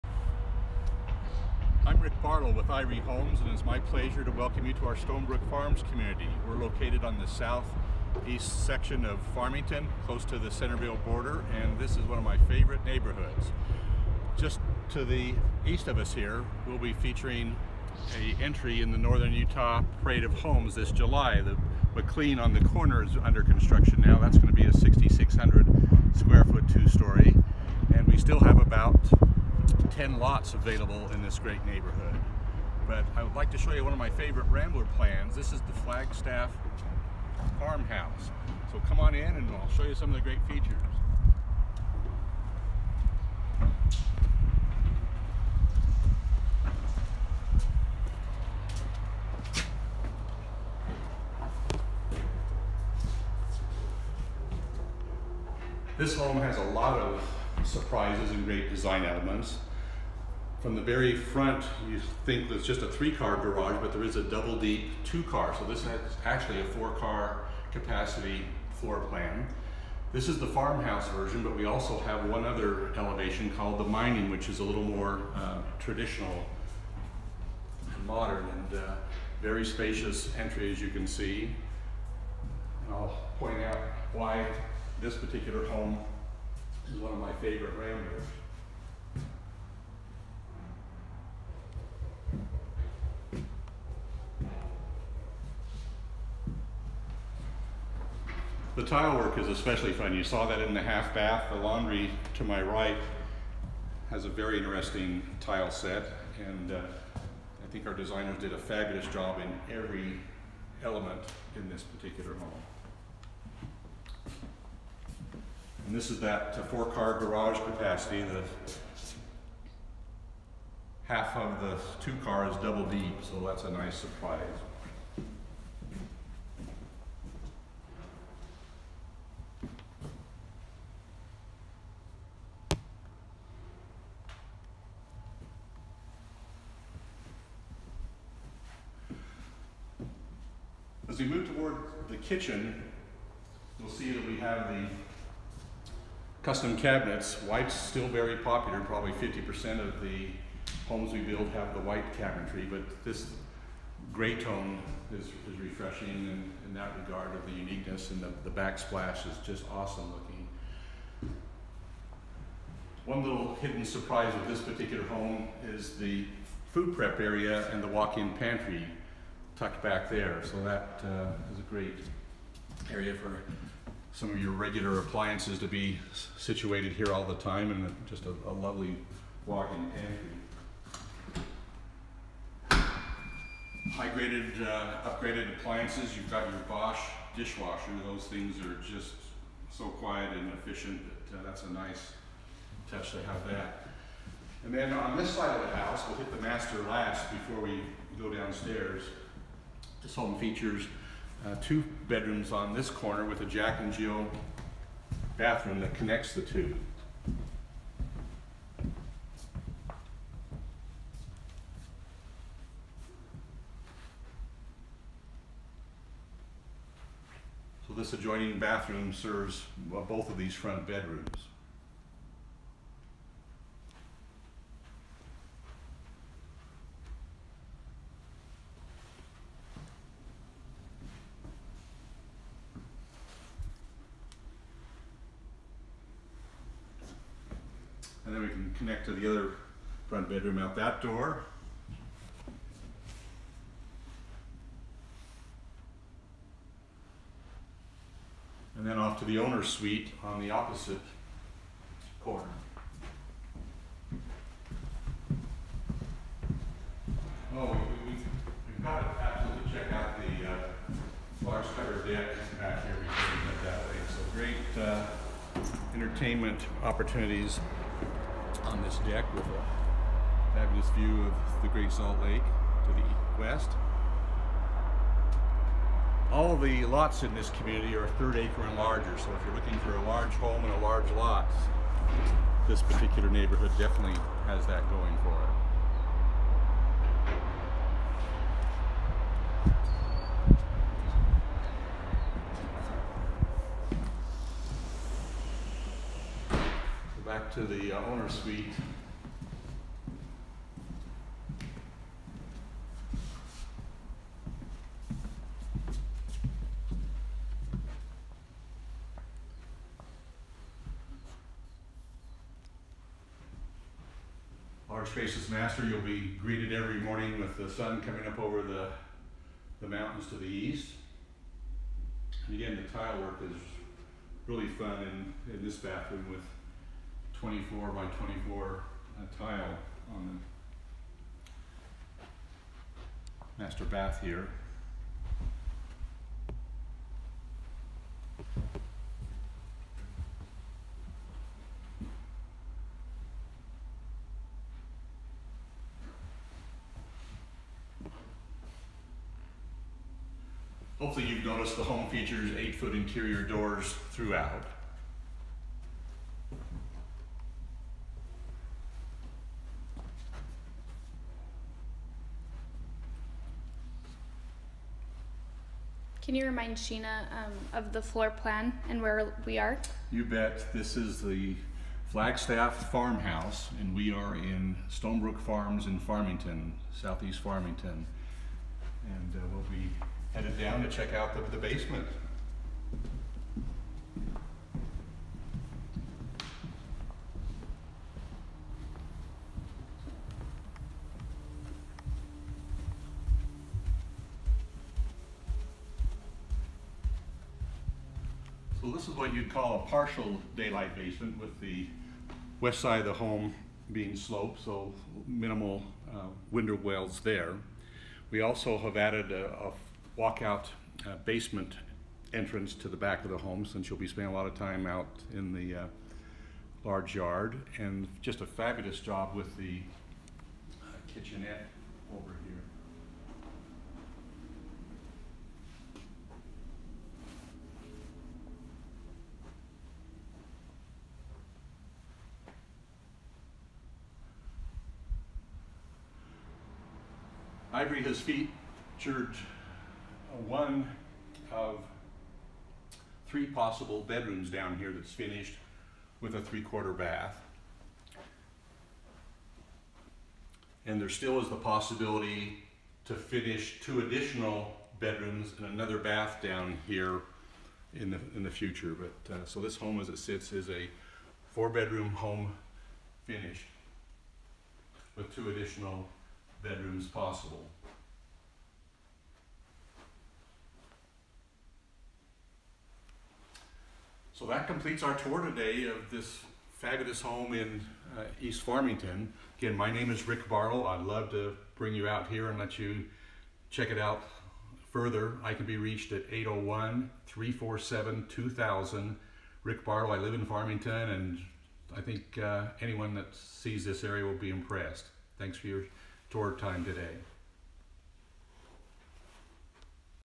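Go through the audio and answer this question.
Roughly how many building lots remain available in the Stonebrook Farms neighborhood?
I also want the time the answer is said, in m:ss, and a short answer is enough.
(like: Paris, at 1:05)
10, at 0:30.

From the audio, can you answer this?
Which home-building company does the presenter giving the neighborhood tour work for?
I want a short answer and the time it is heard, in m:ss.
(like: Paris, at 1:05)
Ivory Homes, at 0:02.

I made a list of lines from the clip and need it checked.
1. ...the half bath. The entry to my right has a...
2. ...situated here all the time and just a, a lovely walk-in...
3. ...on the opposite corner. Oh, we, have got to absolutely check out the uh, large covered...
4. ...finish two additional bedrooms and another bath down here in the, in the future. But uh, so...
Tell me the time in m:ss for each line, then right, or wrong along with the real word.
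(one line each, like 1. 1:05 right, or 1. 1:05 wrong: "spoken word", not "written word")
1. 1:40 wrong: "laundry", not "entry"
2. 2:56 right
3. 4:10 right
4. 7:33 right.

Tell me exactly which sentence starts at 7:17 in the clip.
Ivory has featured one of three possible bedrooms down here that's finished with a three-quarter bath.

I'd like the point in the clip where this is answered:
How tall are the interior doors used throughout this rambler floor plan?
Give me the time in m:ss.
5:52.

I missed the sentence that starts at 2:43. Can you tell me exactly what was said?
One little hidden surprise of this particular home is the food prep area and the walk-in pantry tucked back there.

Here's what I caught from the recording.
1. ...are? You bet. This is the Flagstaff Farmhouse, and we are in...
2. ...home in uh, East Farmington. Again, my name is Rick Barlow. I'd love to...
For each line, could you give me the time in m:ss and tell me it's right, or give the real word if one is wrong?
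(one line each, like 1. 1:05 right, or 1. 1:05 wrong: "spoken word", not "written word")
1. 6:09 right
2. 7:57 right.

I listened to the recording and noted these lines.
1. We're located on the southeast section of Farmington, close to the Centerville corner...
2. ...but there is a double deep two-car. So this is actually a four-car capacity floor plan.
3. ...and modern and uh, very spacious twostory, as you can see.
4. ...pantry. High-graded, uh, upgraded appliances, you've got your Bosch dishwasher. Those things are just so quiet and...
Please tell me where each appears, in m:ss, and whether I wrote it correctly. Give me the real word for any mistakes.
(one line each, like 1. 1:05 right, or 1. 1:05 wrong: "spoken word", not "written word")
1. 0:06 wrong: "border", not "corner"
2. 1:03 right
3. 1:17 wrong: "entry", not "twostory"
4. 3:02 right.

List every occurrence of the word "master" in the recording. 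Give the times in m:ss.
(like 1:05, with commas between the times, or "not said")
3:16, 5:15, 5:33.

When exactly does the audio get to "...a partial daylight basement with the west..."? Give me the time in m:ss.
6:39.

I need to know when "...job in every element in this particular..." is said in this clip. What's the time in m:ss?
1:49.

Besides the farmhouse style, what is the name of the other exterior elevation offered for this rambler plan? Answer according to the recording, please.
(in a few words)
Mining.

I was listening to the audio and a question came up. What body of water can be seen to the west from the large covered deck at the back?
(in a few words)
Great Salt Lake.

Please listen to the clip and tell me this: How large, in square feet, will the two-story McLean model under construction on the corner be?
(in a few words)
6,600.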